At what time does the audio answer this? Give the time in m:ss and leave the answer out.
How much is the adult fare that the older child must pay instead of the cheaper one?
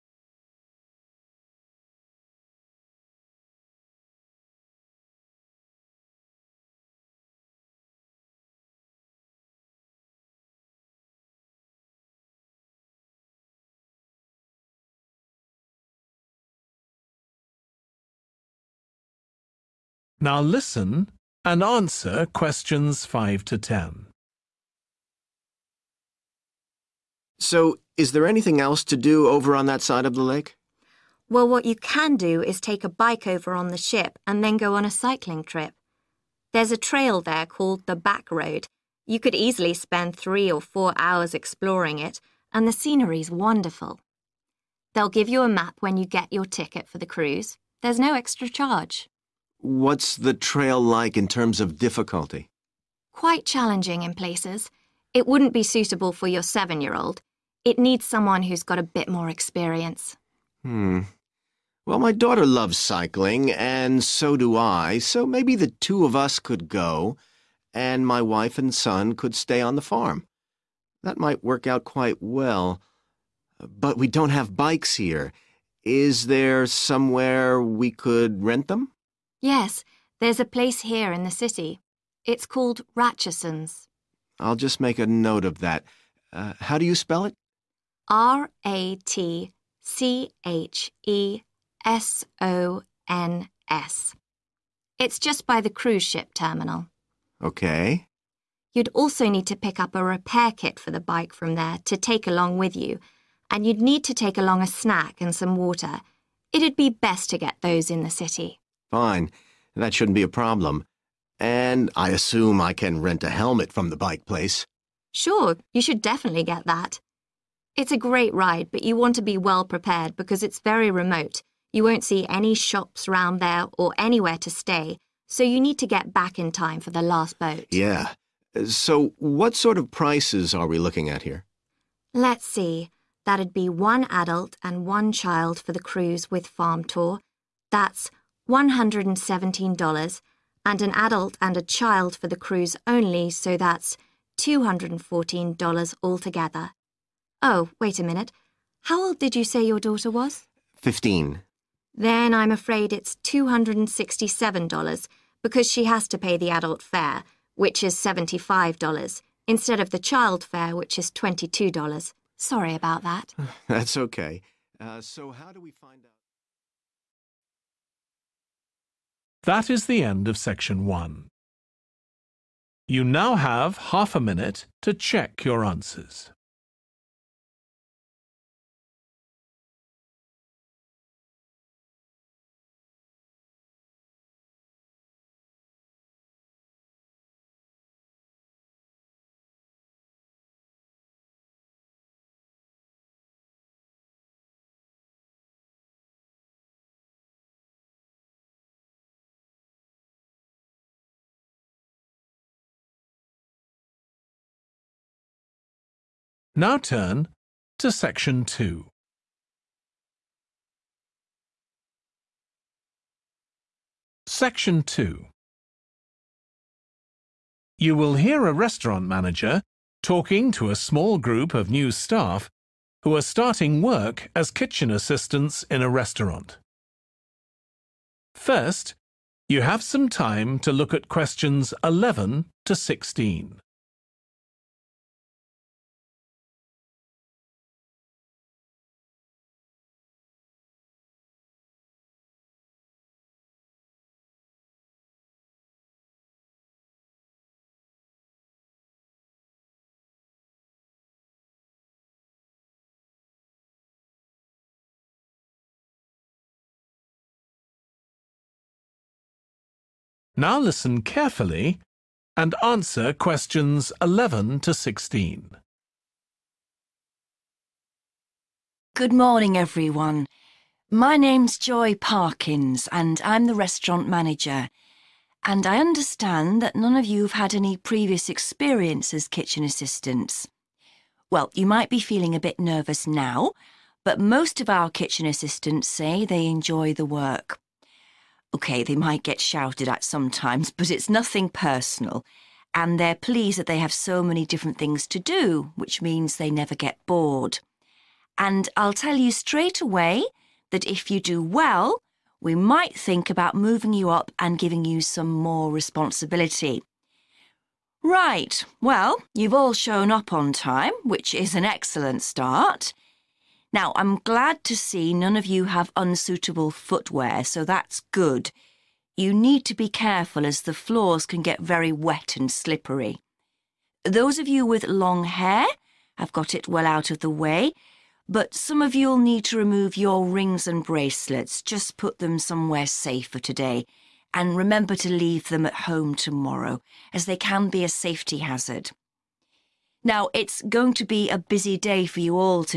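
2:37.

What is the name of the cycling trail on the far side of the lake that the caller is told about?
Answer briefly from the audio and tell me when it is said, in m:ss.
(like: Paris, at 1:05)
Back Road, at 0:37.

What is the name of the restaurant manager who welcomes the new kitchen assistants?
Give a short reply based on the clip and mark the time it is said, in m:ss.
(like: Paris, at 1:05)
Joy Parkins, at 4:31.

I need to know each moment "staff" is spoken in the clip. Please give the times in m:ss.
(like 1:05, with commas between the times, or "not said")
3:41.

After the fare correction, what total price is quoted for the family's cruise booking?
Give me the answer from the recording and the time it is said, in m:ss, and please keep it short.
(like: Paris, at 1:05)
$267, at 2:33.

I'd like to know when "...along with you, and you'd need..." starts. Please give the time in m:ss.
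1:42.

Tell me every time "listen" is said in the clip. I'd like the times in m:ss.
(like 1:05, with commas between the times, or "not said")
0:20, 4:20.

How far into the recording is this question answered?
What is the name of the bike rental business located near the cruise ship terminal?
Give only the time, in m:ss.
1:22.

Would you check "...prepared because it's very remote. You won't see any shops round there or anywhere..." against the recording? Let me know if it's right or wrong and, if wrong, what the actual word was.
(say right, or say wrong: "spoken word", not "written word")
right.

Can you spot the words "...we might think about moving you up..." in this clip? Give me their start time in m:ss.
5:02.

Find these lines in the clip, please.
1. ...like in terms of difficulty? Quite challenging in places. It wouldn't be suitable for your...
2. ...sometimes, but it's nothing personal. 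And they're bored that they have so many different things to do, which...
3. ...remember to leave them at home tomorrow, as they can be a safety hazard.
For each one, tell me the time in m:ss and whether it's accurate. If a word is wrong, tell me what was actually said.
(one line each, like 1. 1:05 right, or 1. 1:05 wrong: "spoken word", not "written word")
1. 0:50 right
2. 4:50 wrong: "pleased", not "bored"
3. 5:34 right.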